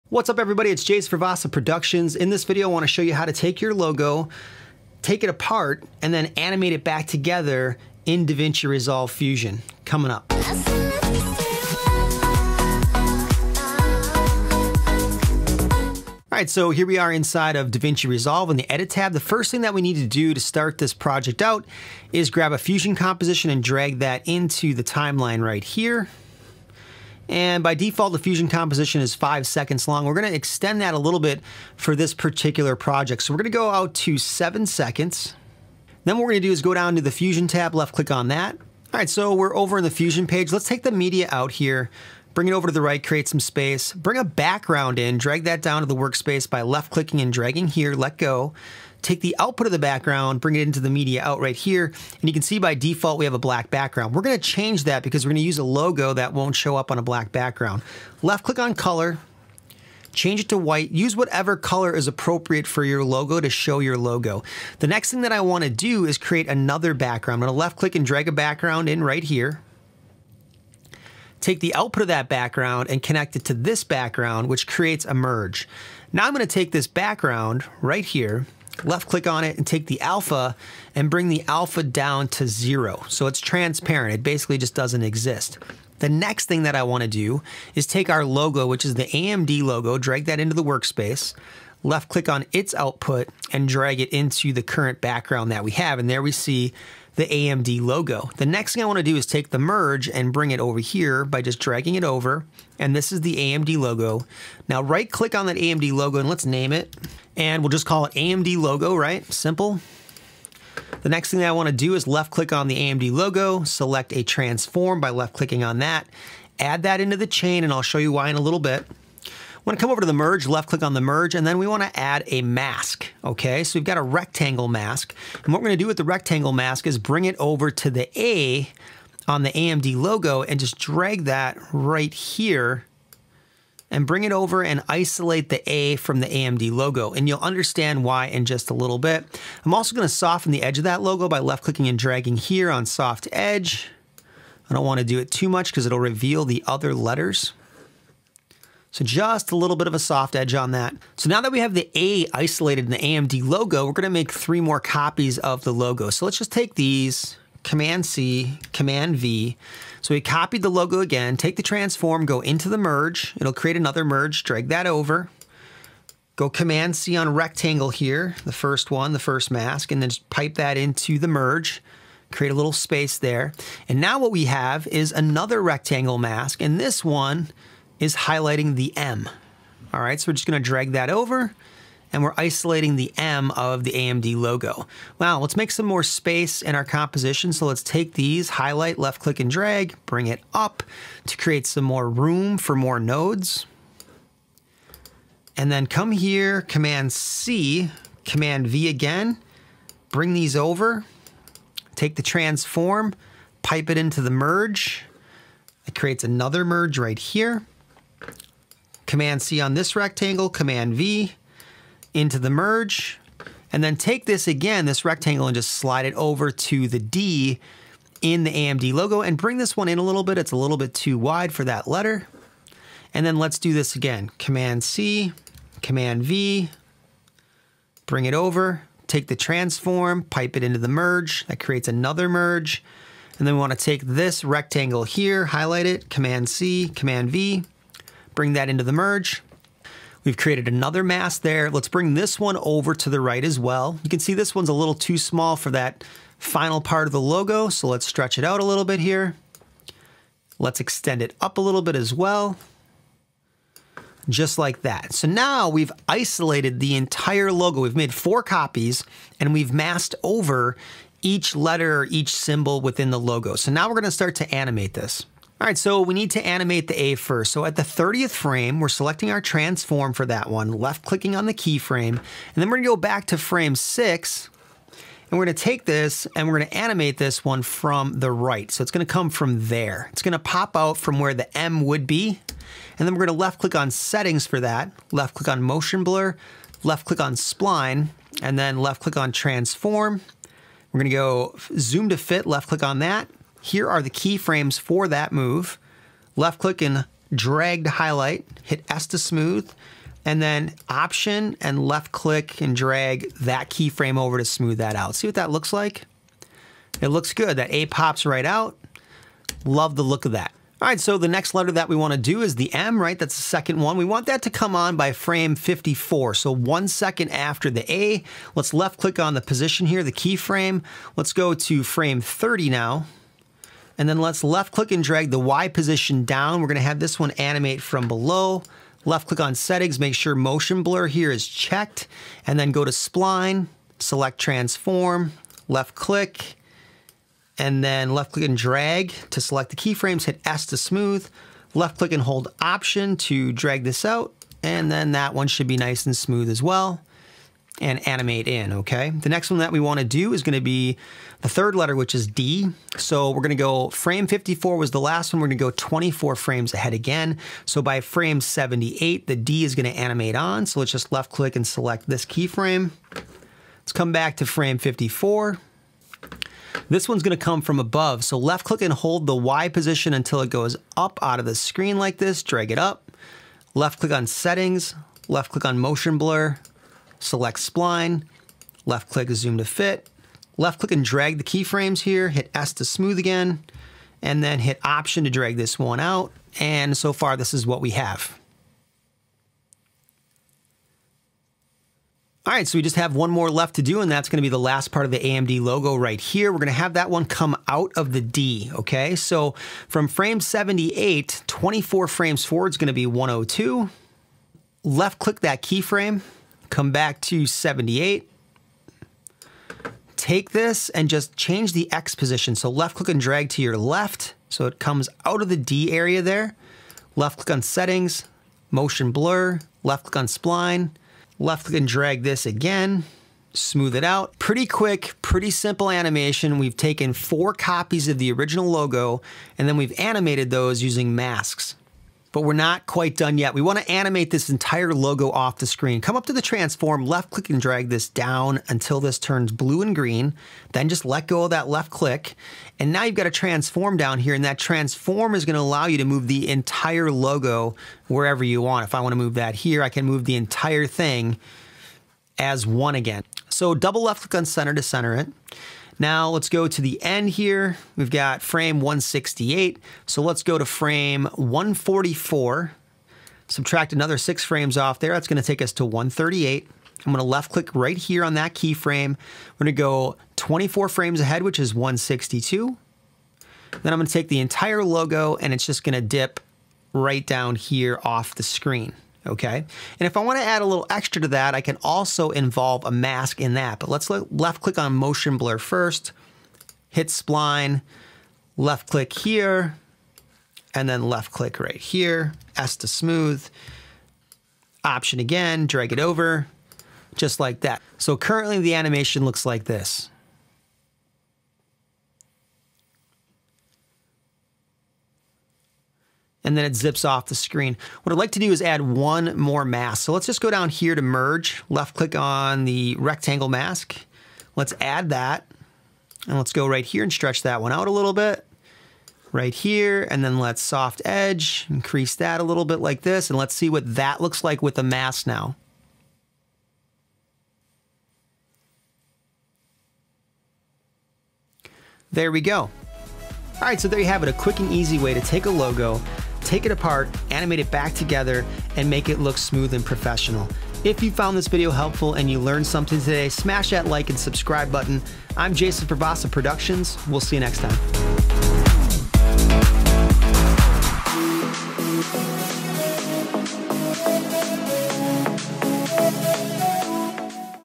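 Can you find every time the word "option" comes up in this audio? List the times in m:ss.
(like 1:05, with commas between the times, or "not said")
5:00, 5:42, 6:24, 8:14.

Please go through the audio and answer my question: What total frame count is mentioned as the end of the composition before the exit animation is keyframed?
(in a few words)
168.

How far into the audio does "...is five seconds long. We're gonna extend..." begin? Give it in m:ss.
0:28.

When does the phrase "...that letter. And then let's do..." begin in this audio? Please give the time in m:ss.
3:41.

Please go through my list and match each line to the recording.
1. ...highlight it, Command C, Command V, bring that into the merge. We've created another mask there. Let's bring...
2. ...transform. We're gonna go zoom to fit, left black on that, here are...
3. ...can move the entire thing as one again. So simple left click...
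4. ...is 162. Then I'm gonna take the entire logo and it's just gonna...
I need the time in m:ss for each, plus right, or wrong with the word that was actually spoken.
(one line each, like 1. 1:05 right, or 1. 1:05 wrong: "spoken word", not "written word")
1. 3:55 right
2. 4:49 wrong: "click", not "black"
3. 7:29 wrong: "double", not "simple"
4. 7:51 right.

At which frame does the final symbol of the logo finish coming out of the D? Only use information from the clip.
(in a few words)
102.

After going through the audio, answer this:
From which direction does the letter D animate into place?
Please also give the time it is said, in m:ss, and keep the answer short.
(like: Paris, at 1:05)
From above, at 6:07.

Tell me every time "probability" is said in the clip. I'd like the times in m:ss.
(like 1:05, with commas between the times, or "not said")
not said.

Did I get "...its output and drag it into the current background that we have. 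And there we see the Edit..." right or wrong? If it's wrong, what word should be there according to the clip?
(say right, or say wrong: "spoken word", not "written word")
wrong: "AMD", not "Edit".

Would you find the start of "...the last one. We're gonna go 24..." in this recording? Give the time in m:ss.
5:54.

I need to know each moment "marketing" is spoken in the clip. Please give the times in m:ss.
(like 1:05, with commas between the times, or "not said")
not said.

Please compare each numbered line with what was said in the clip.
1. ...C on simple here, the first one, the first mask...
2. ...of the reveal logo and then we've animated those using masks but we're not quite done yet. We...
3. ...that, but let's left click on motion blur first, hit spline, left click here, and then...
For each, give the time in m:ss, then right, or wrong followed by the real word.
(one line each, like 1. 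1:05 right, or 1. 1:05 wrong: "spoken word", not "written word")
1. 2:46 wrong: "rectangle", not "simple"
2. 7:08 wrong: "original", not "reveal"
3. 8:03 right.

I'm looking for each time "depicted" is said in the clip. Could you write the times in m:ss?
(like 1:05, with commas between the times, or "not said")
not said.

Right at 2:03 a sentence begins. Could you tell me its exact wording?
So we've got a rectangle mask.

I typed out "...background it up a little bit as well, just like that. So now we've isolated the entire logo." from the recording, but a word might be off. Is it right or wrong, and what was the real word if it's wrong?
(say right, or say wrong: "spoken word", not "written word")
wrong: "extend", not "background".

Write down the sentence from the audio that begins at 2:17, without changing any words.
And you'll understand why in just a little bit.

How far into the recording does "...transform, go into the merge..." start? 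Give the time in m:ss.
2:41.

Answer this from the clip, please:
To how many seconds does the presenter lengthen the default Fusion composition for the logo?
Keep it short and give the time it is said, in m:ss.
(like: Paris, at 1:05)
7 seconds, at 0:34.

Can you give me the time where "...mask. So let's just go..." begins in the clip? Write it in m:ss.
8:29.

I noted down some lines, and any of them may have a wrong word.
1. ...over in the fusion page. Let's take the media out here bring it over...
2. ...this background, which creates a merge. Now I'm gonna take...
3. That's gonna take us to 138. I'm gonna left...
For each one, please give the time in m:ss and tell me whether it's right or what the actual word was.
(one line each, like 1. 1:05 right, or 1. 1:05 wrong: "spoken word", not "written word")
1. 0:39 right
2. 1:13 right
3. 7:45 right.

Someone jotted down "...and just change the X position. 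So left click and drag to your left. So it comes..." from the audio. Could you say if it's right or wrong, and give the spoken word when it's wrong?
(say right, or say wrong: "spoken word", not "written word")
right.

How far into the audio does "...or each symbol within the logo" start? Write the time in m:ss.
4:22.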